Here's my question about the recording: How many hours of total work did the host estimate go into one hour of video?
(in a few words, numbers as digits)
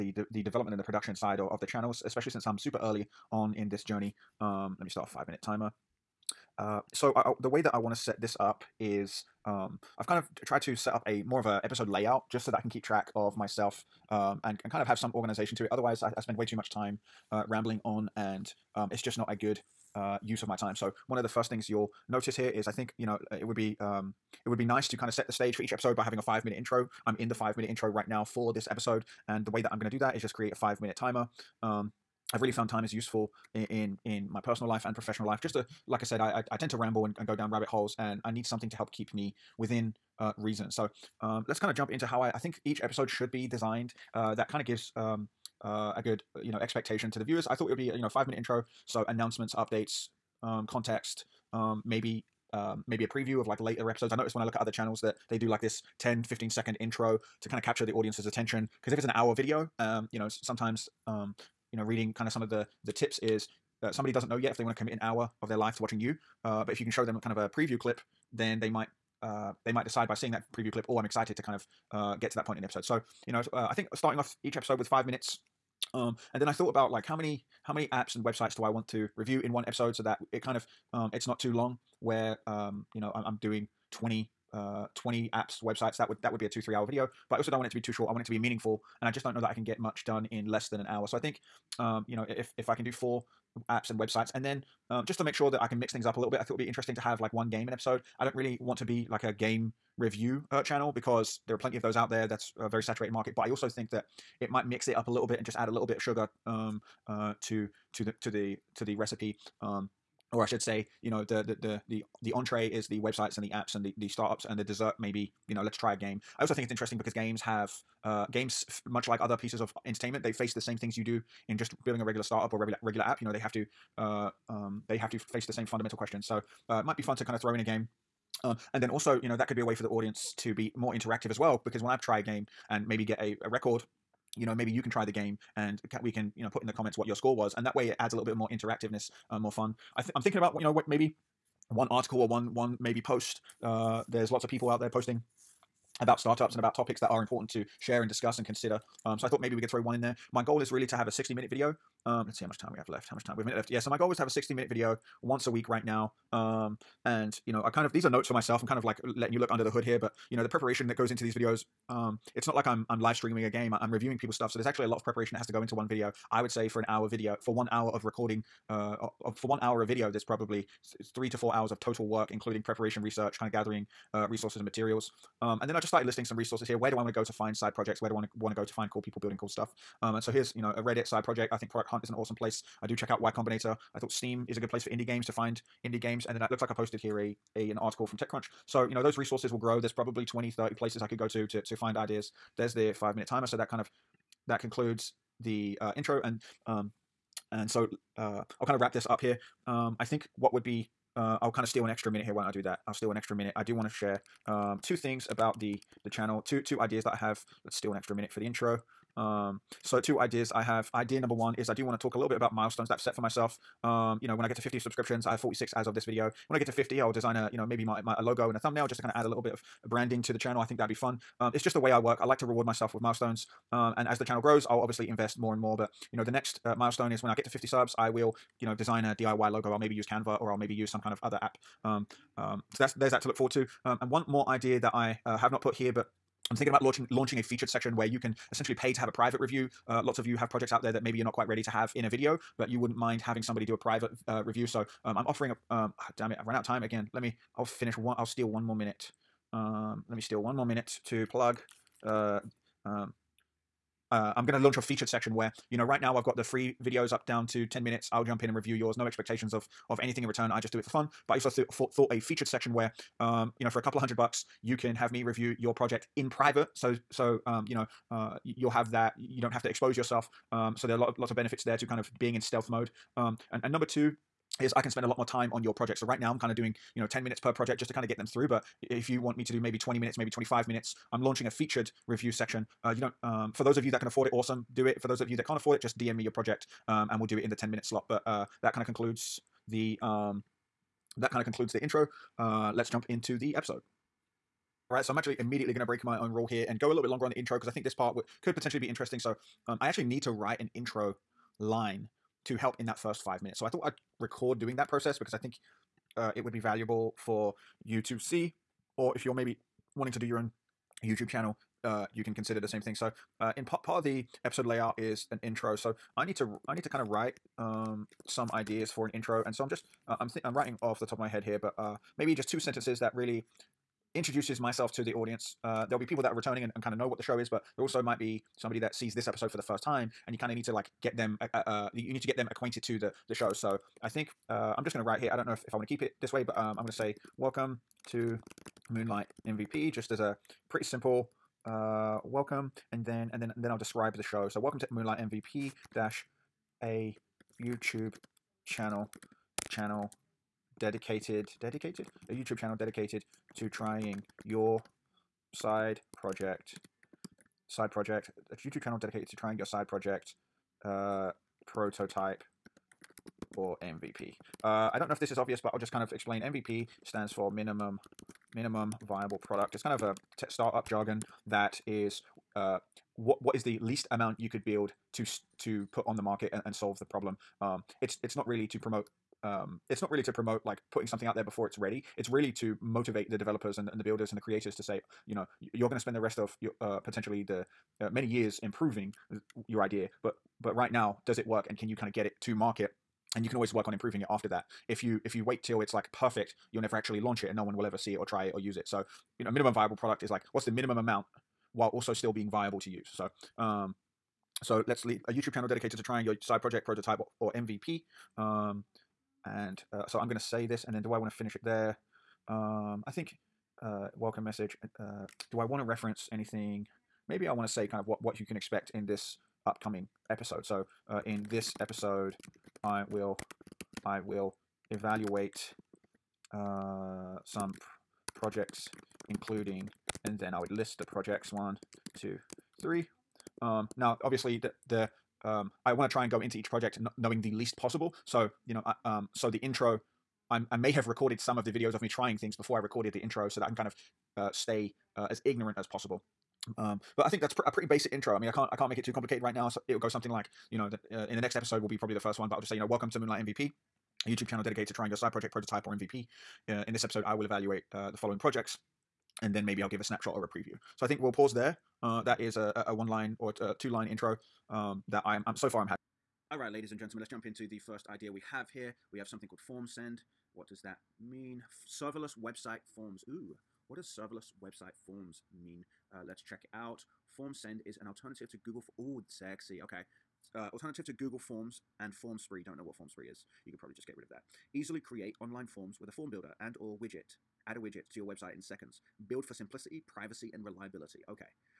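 3 to 4 hours.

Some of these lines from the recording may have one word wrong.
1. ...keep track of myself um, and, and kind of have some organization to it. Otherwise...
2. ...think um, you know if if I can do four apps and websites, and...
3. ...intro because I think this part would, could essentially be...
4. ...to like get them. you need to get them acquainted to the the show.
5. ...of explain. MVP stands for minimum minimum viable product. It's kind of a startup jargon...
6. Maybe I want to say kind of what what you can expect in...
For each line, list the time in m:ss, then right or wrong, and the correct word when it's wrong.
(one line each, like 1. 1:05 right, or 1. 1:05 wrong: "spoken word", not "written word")
1. 0:12 right
2. 1:31 right
3. 4:57 wrong: "potentially", not "essentially"
4. 5:30 right
5. 6:06 right
6. 6:57 right.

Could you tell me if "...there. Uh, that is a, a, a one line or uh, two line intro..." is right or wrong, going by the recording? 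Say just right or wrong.
right.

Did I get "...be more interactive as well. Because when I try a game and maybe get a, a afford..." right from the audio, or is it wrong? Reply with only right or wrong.
wrong.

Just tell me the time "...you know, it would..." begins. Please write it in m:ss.
0:22.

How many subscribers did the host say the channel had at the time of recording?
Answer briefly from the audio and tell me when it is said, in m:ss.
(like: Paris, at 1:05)
46, at 3:35.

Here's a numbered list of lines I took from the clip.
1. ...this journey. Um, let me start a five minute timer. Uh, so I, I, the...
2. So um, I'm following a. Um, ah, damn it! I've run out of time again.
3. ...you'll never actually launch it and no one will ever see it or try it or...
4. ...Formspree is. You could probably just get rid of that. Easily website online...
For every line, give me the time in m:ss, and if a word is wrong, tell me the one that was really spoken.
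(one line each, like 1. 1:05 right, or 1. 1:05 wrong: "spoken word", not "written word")
1. 0:03 right
2. 4:04 wrong: "offering", not "following"
3. 6:36 right
4. 8:02 wrong: "create", not "website".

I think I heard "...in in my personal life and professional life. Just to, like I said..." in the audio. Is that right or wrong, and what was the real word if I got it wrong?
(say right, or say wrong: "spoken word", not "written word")
right.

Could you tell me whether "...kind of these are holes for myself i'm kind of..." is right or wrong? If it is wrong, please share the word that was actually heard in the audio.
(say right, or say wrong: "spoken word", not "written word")
wrong: "notes", not "holes".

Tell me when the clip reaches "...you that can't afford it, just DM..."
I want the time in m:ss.
4:45.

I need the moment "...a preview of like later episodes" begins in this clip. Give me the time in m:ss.
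0:53.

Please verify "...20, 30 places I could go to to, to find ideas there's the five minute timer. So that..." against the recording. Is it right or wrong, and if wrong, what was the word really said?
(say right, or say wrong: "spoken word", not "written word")
right.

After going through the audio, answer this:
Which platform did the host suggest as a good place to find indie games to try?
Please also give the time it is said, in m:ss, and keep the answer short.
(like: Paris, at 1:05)
Steam, at 3:03.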